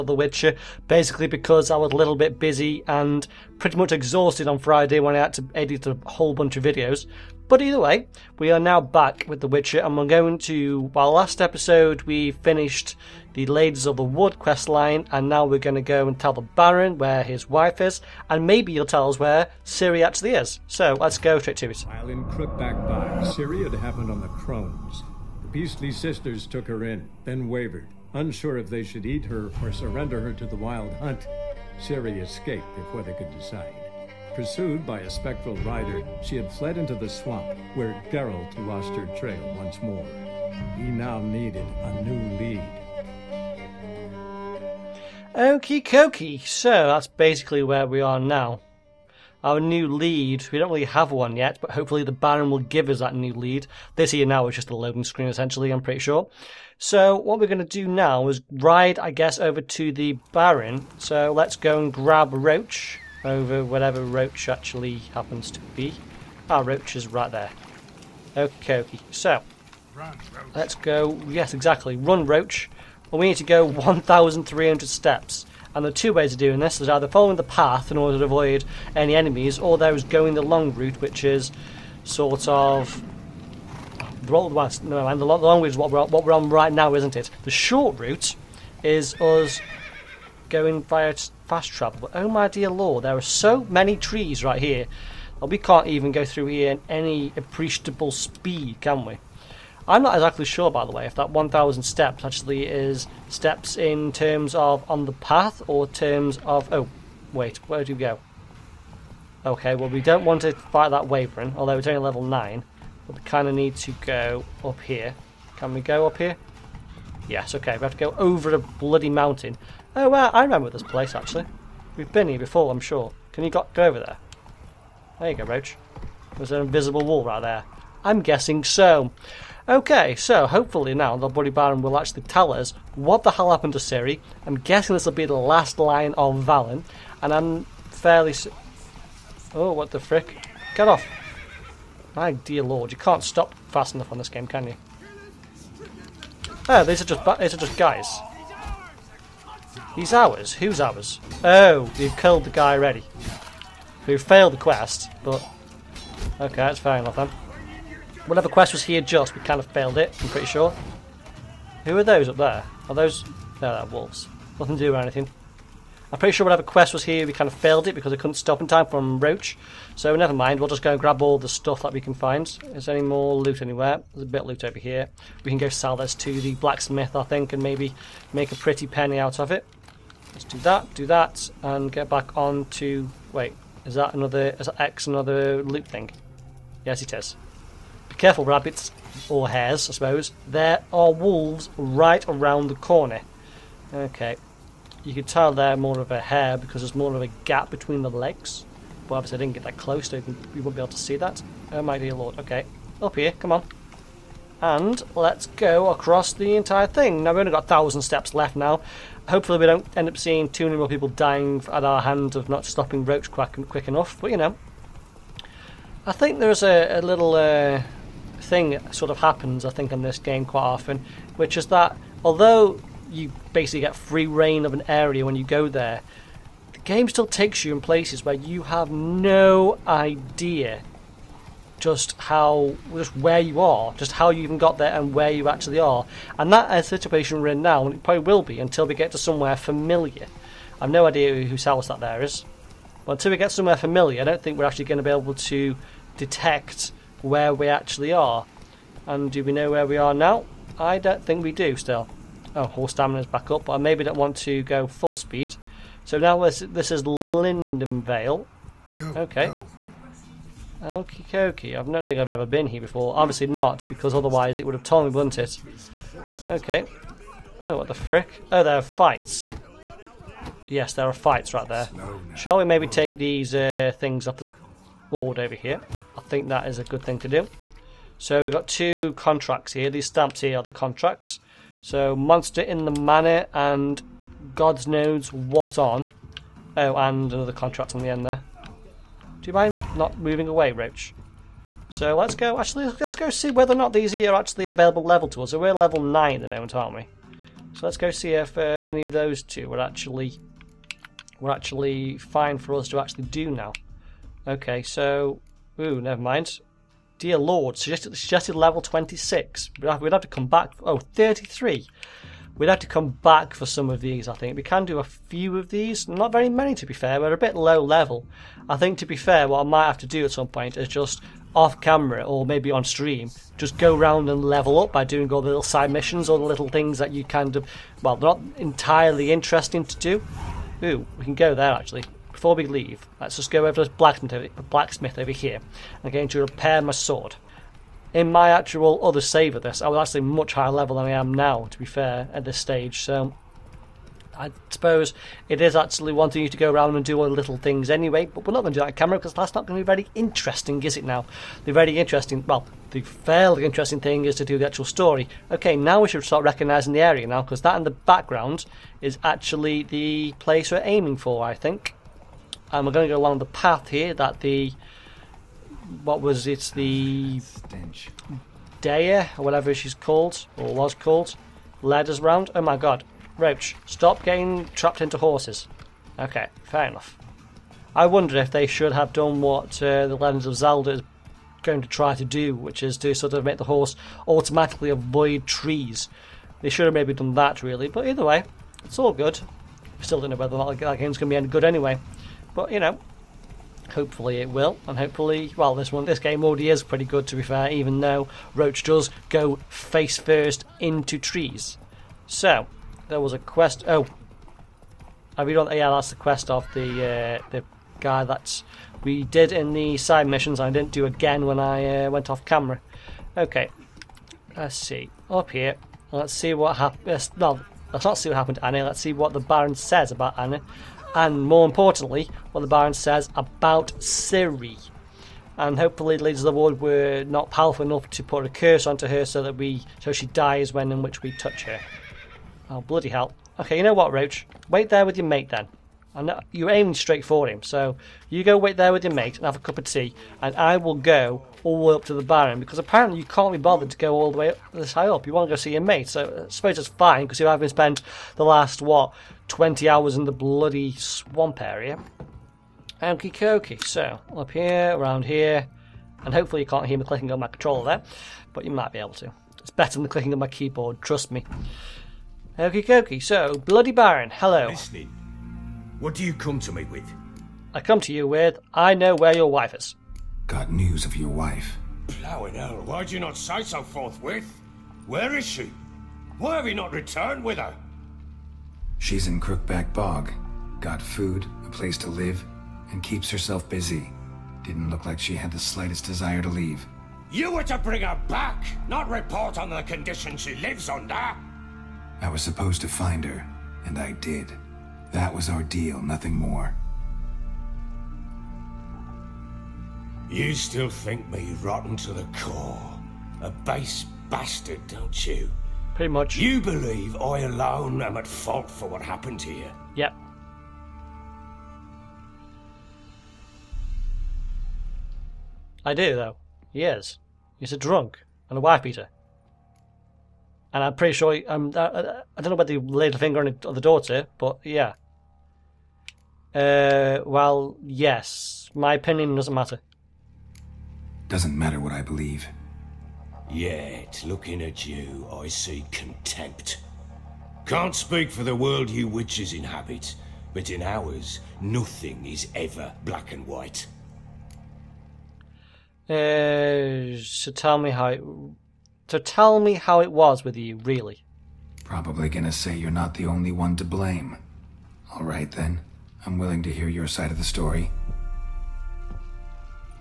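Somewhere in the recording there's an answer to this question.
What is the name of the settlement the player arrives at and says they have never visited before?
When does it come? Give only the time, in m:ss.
4:17.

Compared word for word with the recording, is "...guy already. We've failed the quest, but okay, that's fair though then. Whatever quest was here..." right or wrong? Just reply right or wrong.
wrong.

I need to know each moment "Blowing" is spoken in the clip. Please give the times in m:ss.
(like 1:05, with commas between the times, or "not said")
7:52.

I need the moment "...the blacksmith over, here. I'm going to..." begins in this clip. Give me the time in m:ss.
5:33.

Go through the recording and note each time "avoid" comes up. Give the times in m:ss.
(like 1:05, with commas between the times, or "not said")
1:18, 6:24.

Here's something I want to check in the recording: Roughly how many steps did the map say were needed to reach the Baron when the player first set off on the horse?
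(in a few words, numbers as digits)
1,300.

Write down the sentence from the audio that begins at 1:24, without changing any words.
Well, no, and the long route is what we're, what we're on right now, isn't it?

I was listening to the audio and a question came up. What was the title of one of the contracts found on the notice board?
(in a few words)
Monster in the Manor.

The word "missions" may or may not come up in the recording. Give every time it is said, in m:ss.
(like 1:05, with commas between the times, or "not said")
5:25, 6:50.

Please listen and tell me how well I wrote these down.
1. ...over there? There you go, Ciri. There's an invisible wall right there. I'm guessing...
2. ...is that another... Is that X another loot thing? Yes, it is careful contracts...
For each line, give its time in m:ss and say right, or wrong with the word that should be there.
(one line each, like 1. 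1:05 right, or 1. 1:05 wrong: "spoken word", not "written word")
1. 2:03 wrong: "Roach", not "Ciri"
2. 3:03 wrong: "rabbits", not "contracts".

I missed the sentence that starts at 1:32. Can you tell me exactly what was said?
But oh my dear lord, there are so many trees right here.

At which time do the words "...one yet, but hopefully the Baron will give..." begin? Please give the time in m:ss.
0:51.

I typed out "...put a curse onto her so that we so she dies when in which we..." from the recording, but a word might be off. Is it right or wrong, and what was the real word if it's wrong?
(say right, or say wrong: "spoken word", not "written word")
right.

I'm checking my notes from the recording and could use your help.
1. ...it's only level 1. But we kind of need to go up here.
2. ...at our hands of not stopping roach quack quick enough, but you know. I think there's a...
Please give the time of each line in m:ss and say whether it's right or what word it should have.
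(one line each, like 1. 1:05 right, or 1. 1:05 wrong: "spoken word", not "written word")
1. 1:51 wrong: "9", not "1"
2. 3:31 right.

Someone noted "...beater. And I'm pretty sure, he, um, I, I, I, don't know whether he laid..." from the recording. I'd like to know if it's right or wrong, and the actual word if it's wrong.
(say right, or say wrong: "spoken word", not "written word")
right.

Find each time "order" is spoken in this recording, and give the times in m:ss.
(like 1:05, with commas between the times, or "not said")
1:17.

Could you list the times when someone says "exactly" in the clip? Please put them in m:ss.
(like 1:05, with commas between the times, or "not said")
1:11, 1:40.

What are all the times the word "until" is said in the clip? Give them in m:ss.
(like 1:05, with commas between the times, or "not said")
3:58, 4:03.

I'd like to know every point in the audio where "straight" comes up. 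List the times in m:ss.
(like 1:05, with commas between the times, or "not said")
0:21, 7:16.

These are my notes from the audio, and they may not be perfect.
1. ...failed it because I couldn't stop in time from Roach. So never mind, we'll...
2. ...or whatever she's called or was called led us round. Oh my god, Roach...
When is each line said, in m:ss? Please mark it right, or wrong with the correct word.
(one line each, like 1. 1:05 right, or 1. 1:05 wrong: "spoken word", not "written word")
1. 2:47 right
2. 6:09 right.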